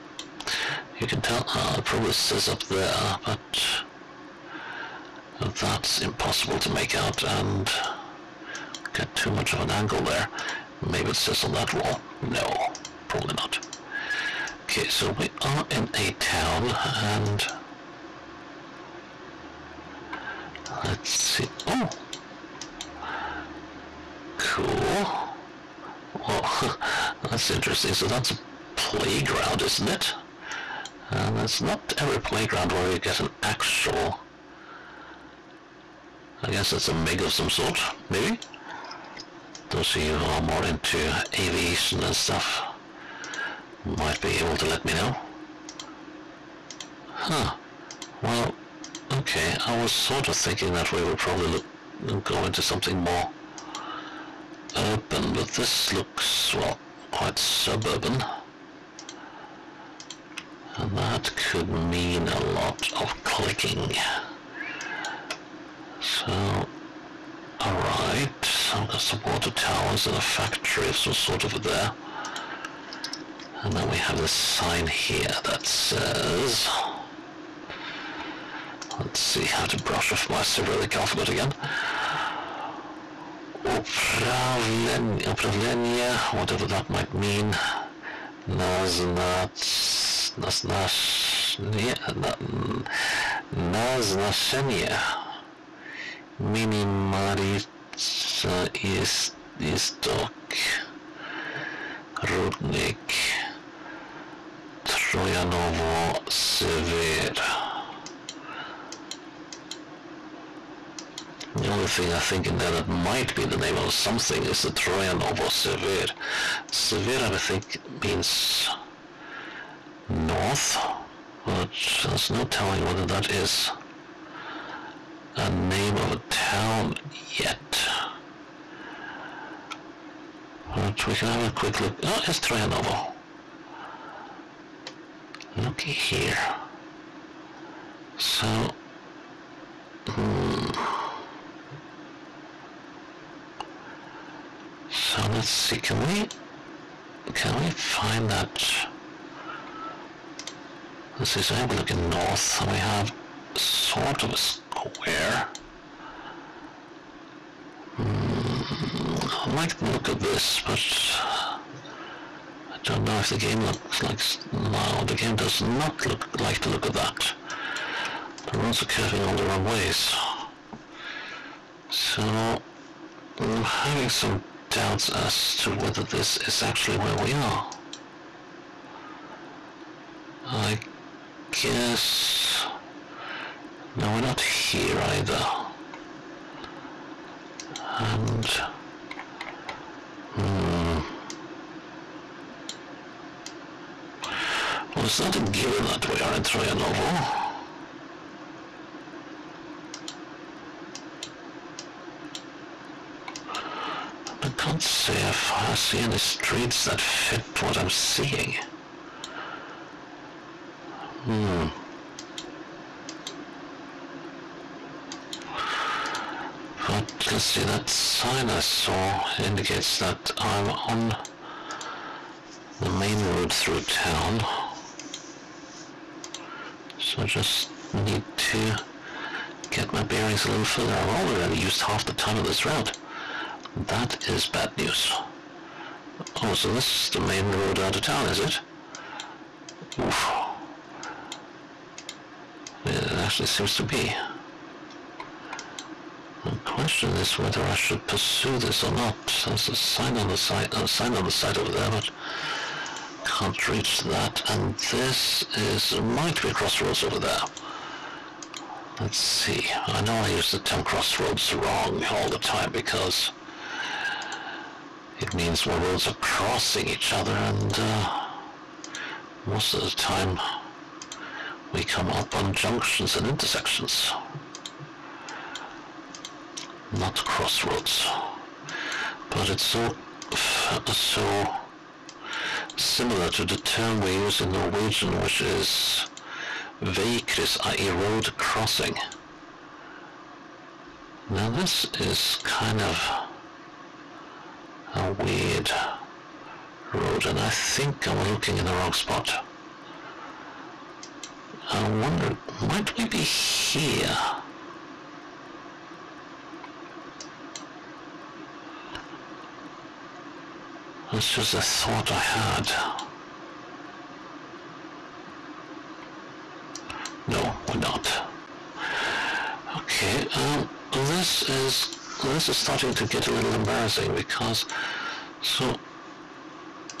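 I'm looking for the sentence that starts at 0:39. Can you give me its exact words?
Those of you who are more into aviation and stuff might be able to let me know.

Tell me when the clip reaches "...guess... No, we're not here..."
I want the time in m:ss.
3:01.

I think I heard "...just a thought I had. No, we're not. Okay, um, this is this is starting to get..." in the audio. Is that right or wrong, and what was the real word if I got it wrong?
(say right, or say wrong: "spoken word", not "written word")
right.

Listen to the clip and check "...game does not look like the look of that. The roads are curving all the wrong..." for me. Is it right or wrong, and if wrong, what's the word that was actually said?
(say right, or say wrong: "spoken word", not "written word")
right.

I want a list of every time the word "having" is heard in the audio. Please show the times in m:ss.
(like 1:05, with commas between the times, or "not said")
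2:53.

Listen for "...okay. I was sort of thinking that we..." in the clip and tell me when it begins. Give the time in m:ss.
0:49.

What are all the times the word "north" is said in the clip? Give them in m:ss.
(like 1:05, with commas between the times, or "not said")
2:00, 2:32.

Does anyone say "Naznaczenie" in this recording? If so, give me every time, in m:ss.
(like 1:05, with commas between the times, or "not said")
1:28.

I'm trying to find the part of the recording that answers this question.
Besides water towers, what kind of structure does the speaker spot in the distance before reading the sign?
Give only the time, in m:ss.
1:10.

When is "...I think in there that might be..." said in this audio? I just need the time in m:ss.
1:52.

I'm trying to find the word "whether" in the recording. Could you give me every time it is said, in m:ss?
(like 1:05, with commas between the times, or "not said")
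2:02, 2:55, 4:07.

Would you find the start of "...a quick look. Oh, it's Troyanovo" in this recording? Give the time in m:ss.
2:11.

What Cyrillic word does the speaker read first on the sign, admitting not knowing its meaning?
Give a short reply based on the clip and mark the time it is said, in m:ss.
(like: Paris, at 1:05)
Upravlenie, at 1:23.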